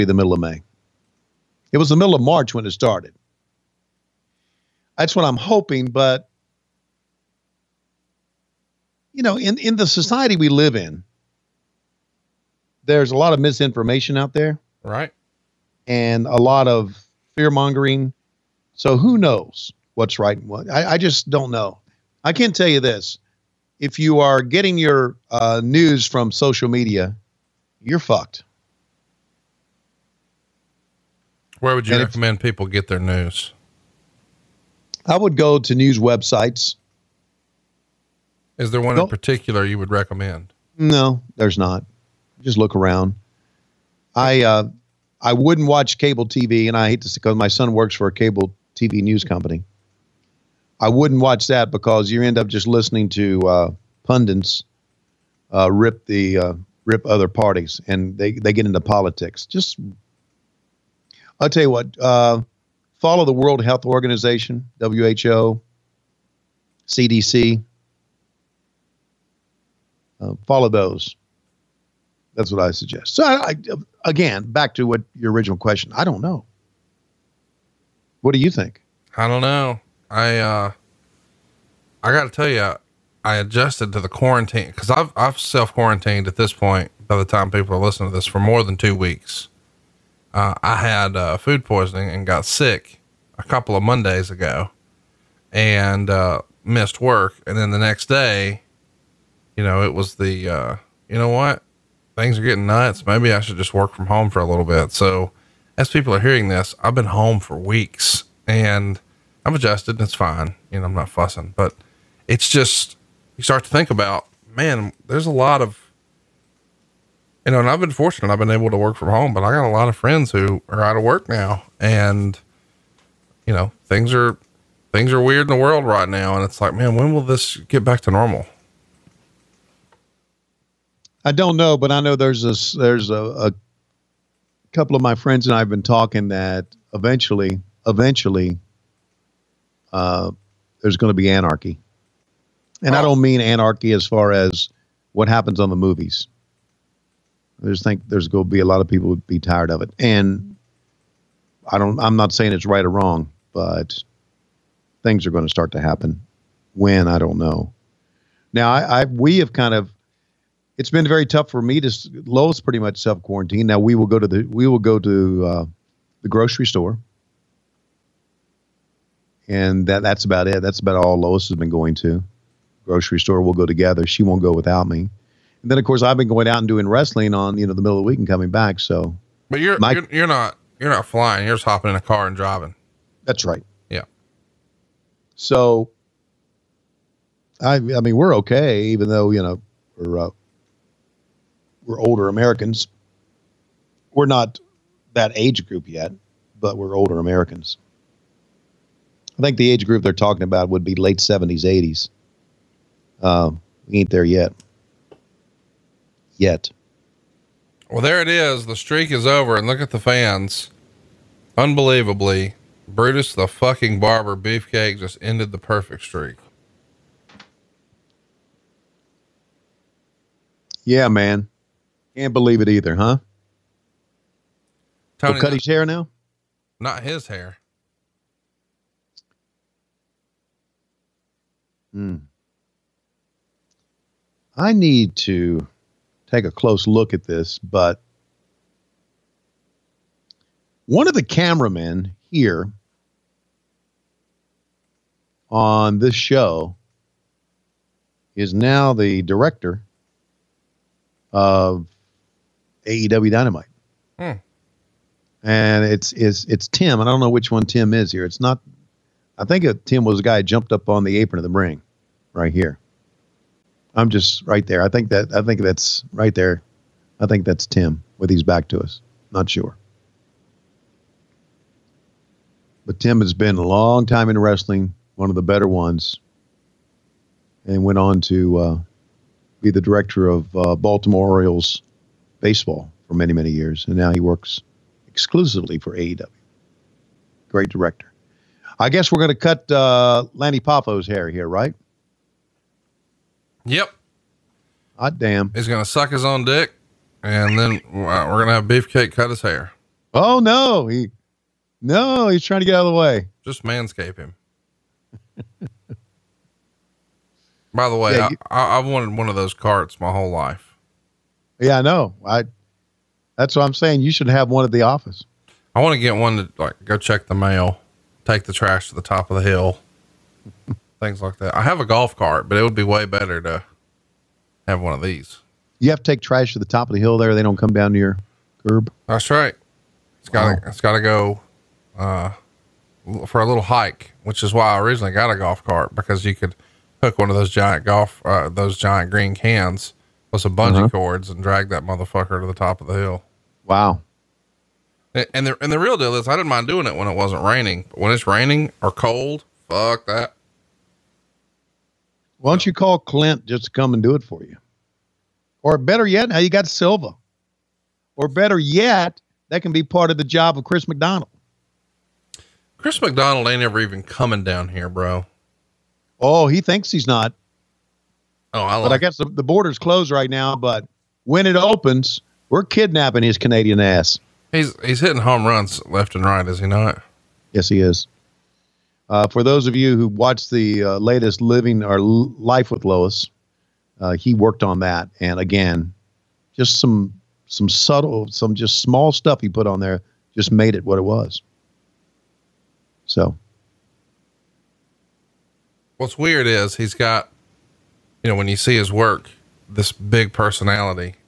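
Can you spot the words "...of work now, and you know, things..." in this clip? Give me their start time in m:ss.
2:00.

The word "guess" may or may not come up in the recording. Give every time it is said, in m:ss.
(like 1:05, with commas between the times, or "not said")
4:48, 6:08.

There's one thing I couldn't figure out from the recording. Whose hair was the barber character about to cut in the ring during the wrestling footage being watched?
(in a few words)
Lanny Poffo.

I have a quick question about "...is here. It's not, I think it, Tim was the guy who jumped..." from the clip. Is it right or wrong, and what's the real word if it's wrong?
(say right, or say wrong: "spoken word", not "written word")
right.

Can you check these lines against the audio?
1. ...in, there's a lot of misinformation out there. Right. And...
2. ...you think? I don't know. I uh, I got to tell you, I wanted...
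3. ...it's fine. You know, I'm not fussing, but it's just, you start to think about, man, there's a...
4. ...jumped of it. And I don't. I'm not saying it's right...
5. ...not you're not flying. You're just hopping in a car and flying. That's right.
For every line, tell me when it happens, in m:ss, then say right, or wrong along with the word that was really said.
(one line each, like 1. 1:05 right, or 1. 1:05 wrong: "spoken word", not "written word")
1. 0:10 right
2. 1:18 wrong: "adjusted", not "wanted"
3. 1:50 right
4. 2:29 wrong: "tired", not "jumped"
5. 3:00 wrong: "driving", not "flying".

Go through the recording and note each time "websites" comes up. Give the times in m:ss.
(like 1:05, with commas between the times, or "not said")
0:35.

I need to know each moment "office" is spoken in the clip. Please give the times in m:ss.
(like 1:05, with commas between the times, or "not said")
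5:14.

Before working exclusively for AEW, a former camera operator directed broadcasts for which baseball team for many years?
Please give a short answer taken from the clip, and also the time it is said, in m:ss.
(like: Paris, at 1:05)
Baltimore Orioles, at 4:40.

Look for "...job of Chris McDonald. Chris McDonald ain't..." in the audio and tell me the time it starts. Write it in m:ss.
6:00.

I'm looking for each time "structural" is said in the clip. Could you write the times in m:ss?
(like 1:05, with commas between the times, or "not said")
not said.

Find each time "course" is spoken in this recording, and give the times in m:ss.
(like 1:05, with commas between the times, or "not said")
2:55.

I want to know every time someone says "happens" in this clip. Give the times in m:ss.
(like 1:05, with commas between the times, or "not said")
2:25, 2:35.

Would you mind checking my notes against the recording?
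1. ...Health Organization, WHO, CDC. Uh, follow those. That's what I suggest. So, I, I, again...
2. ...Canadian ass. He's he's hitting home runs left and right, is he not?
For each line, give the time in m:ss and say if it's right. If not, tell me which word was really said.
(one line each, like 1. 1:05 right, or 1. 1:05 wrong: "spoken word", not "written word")
1. 1:03 right
2. 6:13 right.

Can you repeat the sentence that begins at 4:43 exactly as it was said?
And now he works exclusively for AEW.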